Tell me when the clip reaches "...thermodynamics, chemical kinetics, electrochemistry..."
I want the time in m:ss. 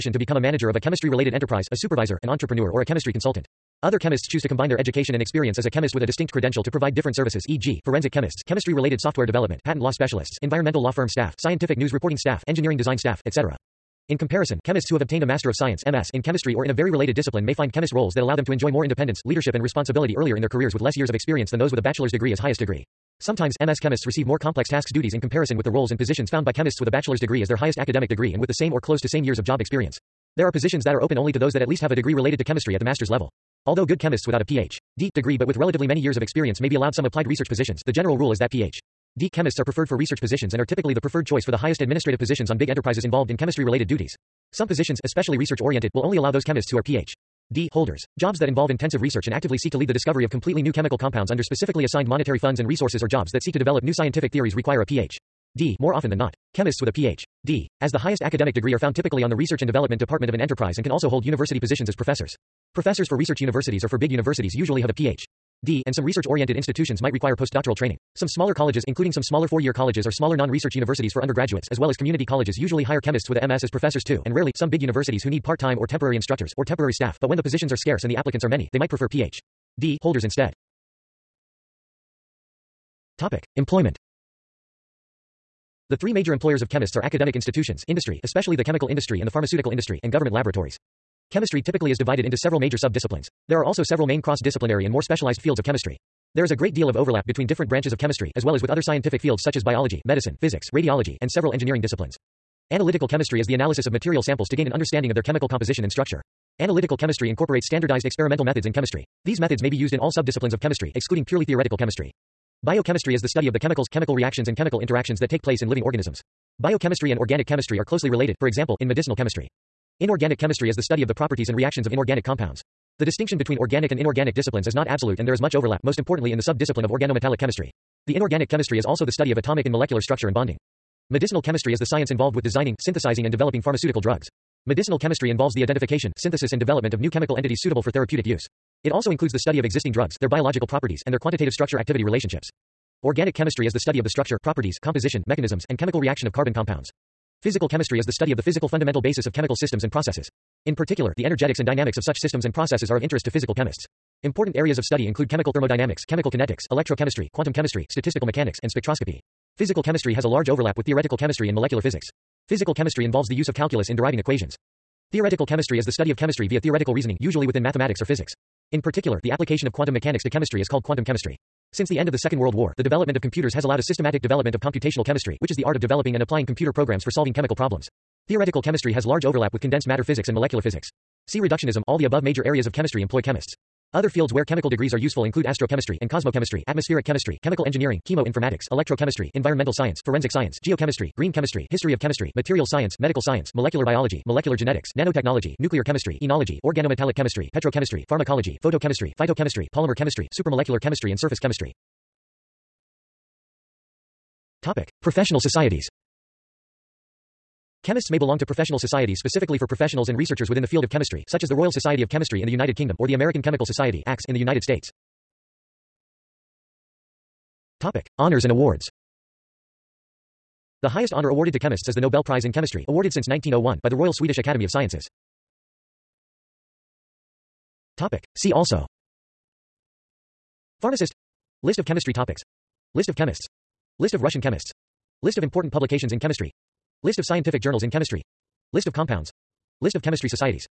2:35.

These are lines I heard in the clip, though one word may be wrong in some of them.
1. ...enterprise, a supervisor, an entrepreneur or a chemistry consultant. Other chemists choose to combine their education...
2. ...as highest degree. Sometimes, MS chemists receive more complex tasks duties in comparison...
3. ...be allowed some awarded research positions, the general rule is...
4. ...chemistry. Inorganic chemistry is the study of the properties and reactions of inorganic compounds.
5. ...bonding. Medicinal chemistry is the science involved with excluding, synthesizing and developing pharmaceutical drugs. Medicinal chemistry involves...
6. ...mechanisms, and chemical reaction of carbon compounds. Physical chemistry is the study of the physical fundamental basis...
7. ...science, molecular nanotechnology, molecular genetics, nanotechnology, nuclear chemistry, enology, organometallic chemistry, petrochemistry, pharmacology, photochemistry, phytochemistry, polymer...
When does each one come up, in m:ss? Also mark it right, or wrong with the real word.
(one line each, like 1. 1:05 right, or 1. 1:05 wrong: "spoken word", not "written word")
1. 0:01 right
2. 0:22 right
3. 0:36 wrong: "applied", not "awarded"
4. 1:59 right
5. 2:10 wrong: "designing", not "excluding"
6. 2:25 right
7. 3:13 wrong: "biology", not "nanotechnology".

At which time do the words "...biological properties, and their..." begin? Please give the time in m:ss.
2:20.